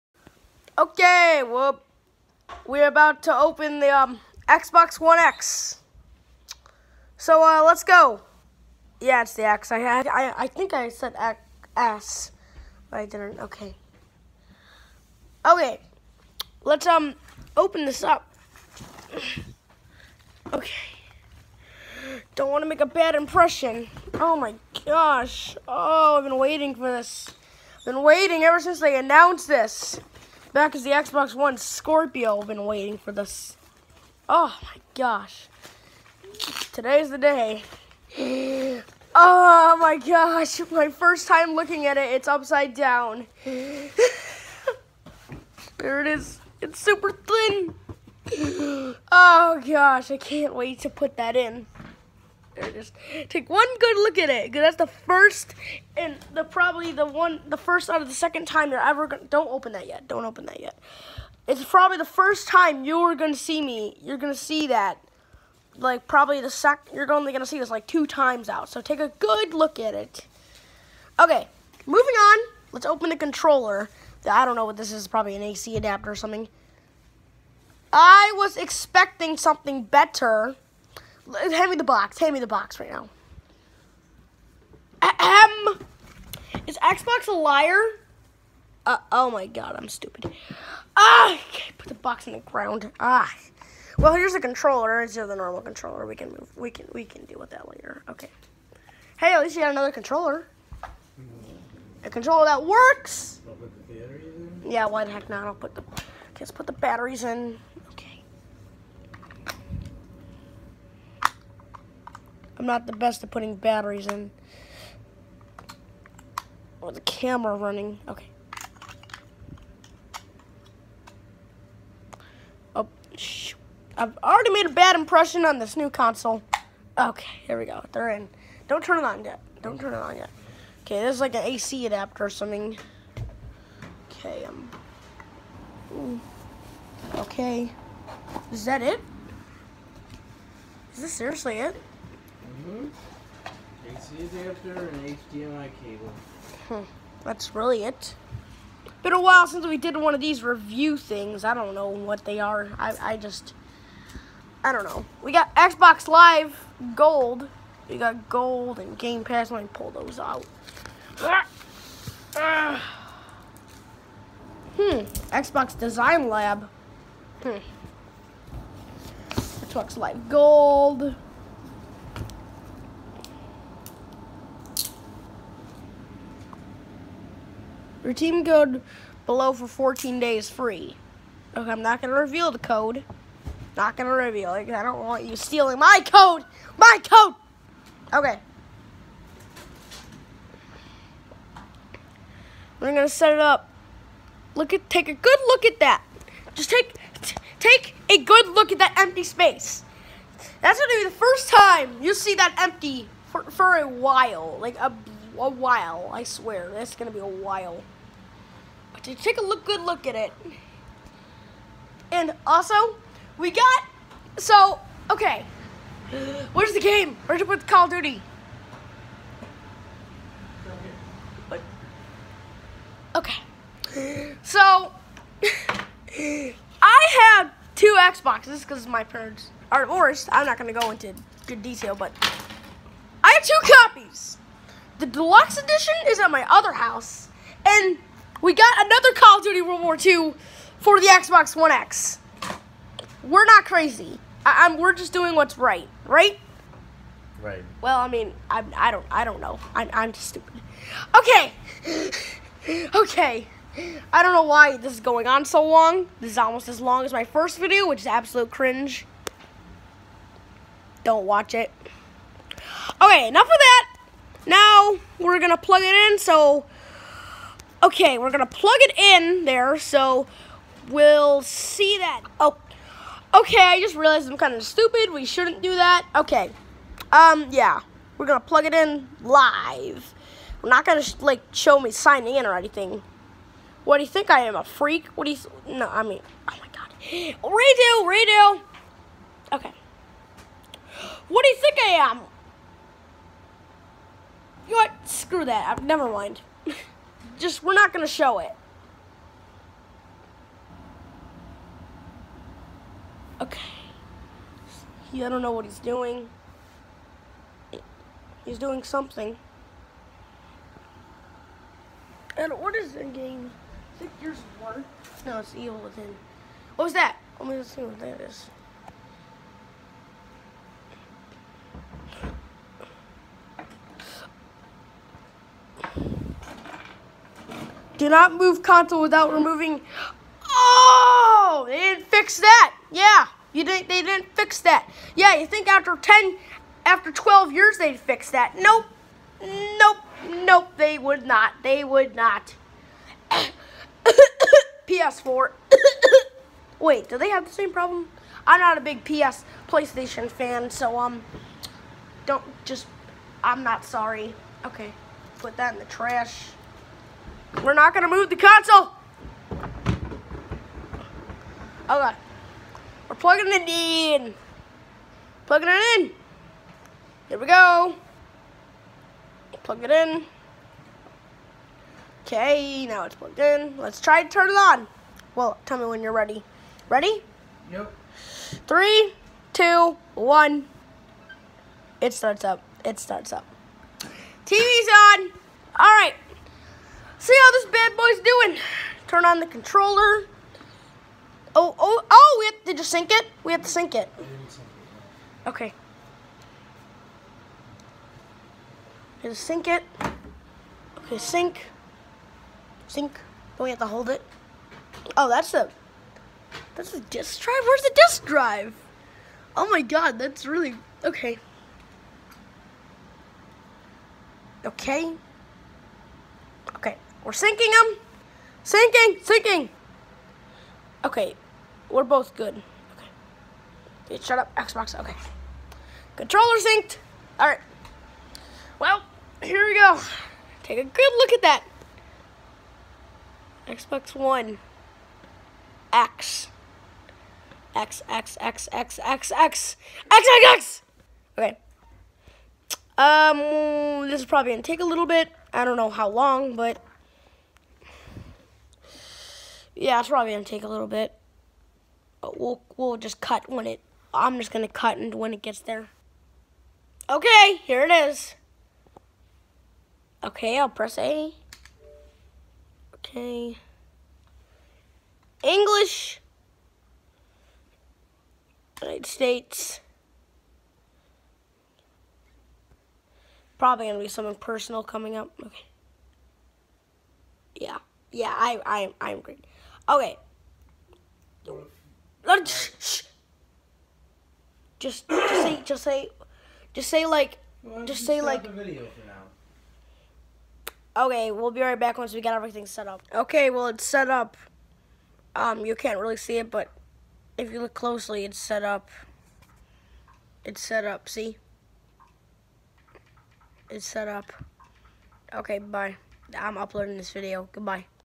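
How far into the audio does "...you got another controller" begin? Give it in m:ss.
1:39.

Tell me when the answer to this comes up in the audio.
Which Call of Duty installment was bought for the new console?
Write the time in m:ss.
3:59.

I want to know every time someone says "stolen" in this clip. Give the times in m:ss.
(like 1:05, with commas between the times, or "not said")
not said.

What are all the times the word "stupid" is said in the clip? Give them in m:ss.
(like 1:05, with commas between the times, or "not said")
1:29, 4:10, 4:34.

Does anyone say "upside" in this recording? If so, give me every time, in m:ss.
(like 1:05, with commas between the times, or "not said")
0:42.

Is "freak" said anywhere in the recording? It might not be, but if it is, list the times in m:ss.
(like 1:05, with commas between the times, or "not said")
4:44.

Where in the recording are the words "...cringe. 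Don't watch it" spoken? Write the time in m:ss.
4:18.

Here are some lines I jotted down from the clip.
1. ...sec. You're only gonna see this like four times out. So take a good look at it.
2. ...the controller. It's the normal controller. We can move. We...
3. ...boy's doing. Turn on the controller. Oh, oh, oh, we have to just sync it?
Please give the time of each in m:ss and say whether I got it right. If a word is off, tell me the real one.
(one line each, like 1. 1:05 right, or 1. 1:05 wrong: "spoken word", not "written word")
1. 1:06 wrong: "two", not "four"
2. 1:34 right
3. 6:27 right.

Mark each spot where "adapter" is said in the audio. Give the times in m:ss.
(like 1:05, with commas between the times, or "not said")
1:15, 2:11.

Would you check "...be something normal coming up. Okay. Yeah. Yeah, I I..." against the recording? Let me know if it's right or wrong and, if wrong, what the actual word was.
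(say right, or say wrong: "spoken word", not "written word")
wrong: "personal", not "normal".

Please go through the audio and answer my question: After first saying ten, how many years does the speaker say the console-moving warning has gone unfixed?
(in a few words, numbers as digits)
12.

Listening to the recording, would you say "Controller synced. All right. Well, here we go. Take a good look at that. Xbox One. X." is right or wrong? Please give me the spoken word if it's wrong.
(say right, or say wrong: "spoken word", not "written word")
right.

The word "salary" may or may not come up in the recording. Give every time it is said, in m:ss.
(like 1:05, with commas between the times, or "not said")
not said.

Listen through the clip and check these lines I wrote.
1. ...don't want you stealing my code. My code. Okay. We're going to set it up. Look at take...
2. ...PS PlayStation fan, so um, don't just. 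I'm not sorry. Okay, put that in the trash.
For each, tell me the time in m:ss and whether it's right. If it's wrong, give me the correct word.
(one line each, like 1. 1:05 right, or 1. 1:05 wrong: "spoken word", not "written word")
1. 3:04 right
2. 5:49 right.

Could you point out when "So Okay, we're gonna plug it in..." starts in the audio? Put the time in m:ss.
4:26.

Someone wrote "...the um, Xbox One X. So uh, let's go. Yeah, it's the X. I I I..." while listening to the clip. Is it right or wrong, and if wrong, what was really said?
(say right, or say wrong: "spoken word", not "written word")
right.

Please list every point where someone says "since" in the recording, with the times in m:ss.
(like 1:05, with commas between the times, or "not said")
0:28, 2:29.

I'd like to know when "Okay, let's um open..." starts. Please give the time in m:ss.
0:15.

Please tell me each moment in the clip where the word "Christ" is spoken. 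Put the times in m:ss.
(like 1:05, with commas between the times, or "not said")
not said.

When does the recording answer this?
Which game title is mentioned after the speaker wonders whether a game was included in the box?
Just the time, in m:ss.
5:15.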